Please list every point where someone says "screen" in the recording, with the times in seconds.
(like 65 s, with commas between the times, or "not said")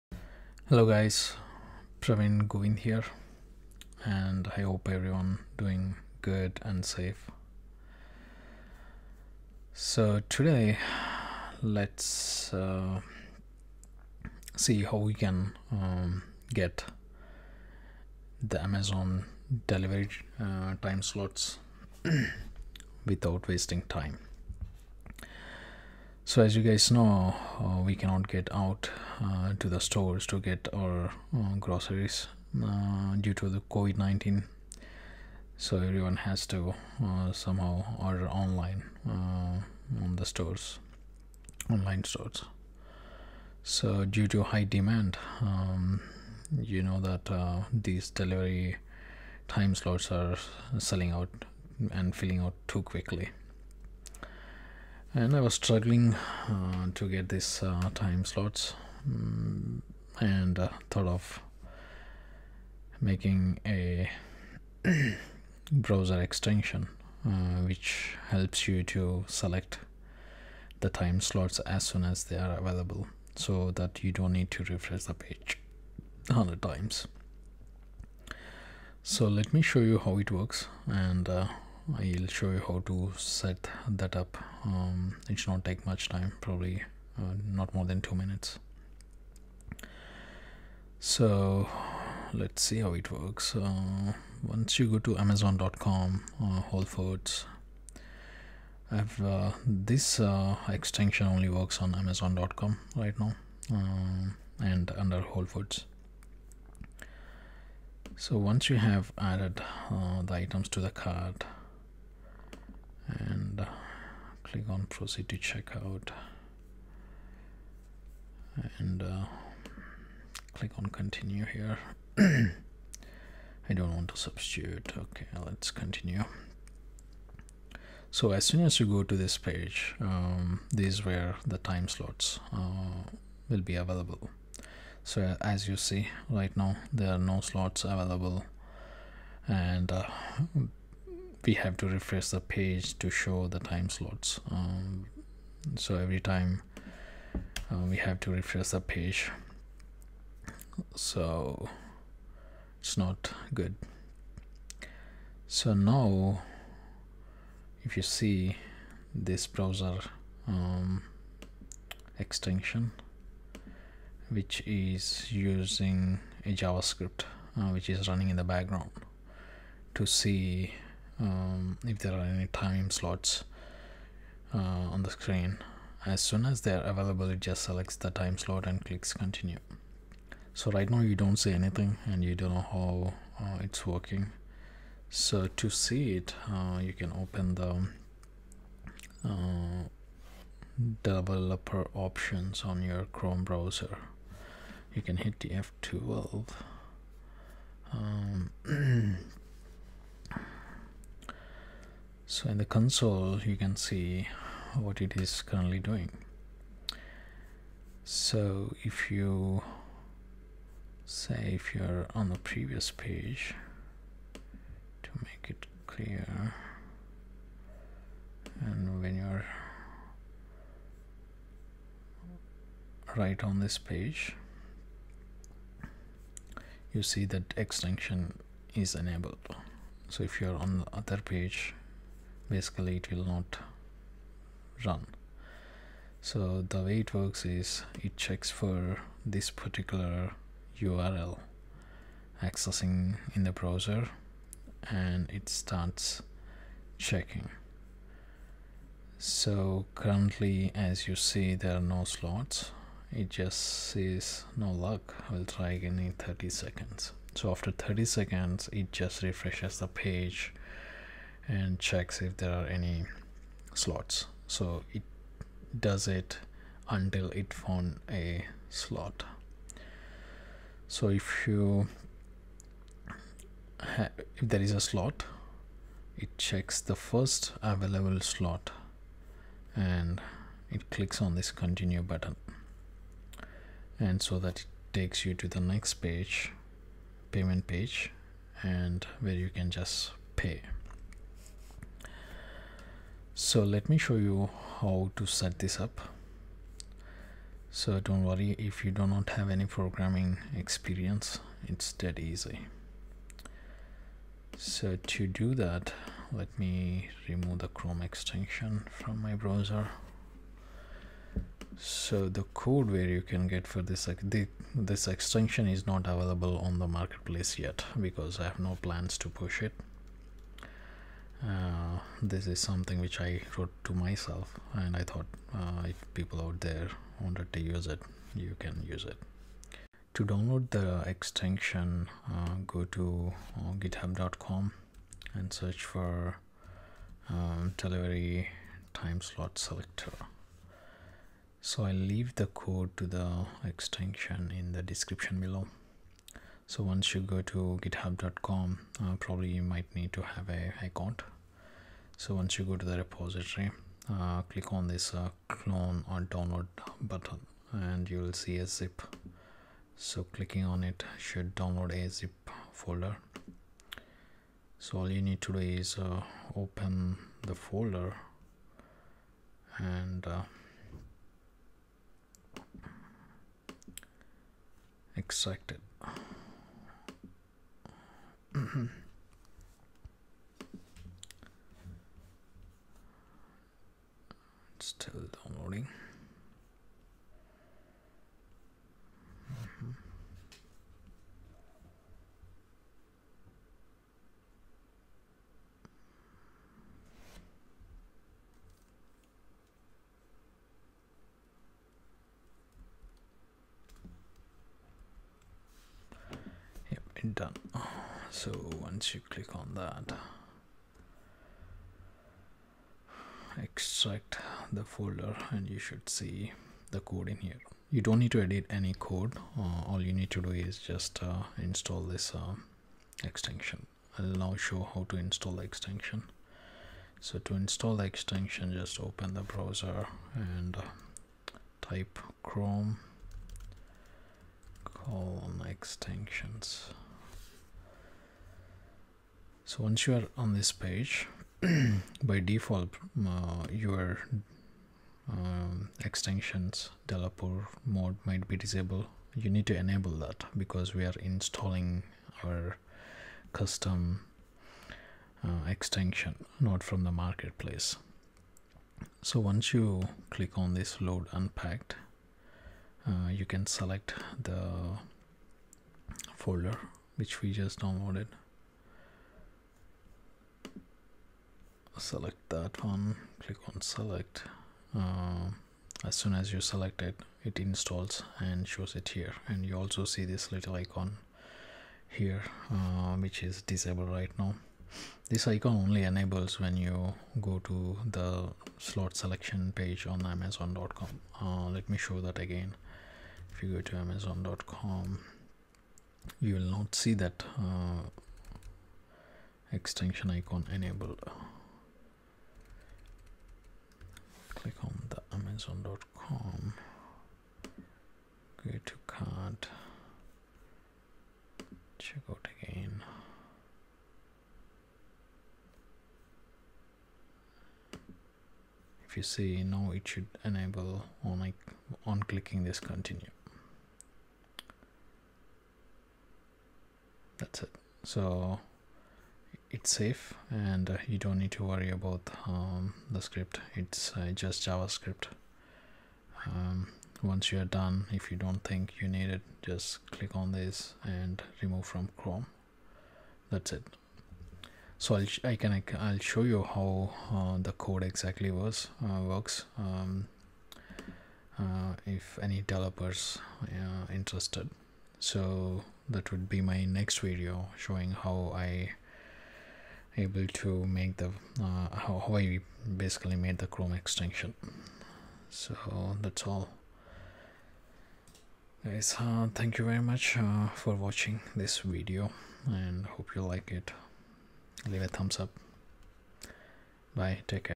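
175 s.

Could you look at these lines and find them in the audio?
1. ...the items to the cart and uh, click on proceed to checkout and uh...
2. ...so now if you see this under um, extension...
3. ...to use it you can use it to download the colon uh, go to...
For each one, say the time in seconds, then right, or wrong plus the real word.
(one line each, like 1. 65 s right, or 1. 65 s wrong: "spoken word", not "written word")
1. 110 s right
2. 155 s wrong: "browser", not "under"
3. 327 s wrong: "extension", not "colon".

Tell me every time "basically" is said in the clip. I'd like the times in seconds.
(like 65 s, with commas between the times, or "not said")
232 s, 562 s.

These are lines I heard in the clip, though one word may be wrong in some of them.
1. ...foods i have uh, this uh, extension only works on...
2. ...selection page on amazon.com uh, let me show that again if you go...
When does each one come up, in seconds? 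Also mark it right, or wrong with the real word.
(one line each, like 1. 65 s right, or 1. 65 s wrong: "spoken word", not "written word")
1. 96 s right
2. 489 s right.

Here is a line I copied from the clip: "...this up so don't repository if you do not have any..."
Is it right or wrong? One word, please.
wrong.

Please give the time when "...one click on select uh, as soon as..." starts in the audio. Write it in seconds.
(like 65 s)
472 s.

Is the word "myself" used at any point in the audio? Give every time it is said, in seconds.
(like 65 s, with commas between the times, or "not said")
323 s.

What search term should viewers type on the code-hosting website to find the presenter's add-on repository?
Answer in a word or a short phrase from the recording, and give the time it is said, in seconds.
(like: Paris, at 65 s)
delivery time slot selector, at 337 s.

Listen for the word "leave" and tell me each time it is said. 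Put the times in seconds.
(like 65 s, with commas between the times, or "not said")
341 s, 574 s.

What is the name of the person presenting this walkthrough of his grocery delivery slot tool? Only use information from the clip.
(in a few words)
Praveen Govind.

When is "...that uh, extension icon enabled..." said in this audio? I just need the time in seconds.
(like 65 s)
497 s.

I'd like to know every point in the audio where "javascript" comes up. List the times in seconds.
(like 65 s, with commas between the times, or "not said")
166 s, 534 s.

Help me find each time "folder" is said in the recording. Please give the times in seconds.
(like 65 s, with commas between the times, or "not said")
362 s, 367 s, 414 s, 466 s.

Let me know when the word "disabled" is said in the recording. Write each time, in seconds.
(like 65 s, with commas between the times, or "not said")
448 s, 483 s.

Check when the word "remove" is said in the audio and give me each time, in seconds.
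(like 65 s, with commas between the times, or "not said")
307 s, 541 s.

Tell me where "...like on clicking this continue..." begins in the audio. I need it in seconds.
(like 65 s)
521 s.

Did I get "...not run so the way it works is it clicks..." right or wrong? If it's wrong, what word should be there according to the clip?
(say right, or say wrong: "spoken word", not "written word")
wrong: "checks", not "clicks".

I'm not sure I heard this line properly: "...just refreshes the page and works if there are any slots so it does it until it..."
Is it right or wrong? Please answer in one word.
wrong.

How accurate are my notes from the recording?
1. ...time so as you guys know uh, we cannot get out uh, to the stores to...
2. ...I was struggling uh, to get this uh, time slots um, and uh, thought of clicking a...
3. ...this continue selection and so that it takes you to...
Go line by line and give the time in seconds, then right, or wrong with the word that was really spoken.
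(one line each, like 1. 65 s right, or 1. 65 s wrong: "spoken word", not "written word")
1. 23 s right
2. 55 s wrong: "making", not "clicking"
3. 281 s wrong: "button", not "selection".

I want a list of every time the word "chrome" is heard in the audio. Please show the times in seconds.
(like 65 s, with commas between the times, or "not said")
193 s, 307 s, 432 s, 542 s, 563 s.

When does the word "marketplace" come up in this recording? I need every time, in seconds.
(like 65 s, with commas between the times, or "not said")
316 s, 457 s.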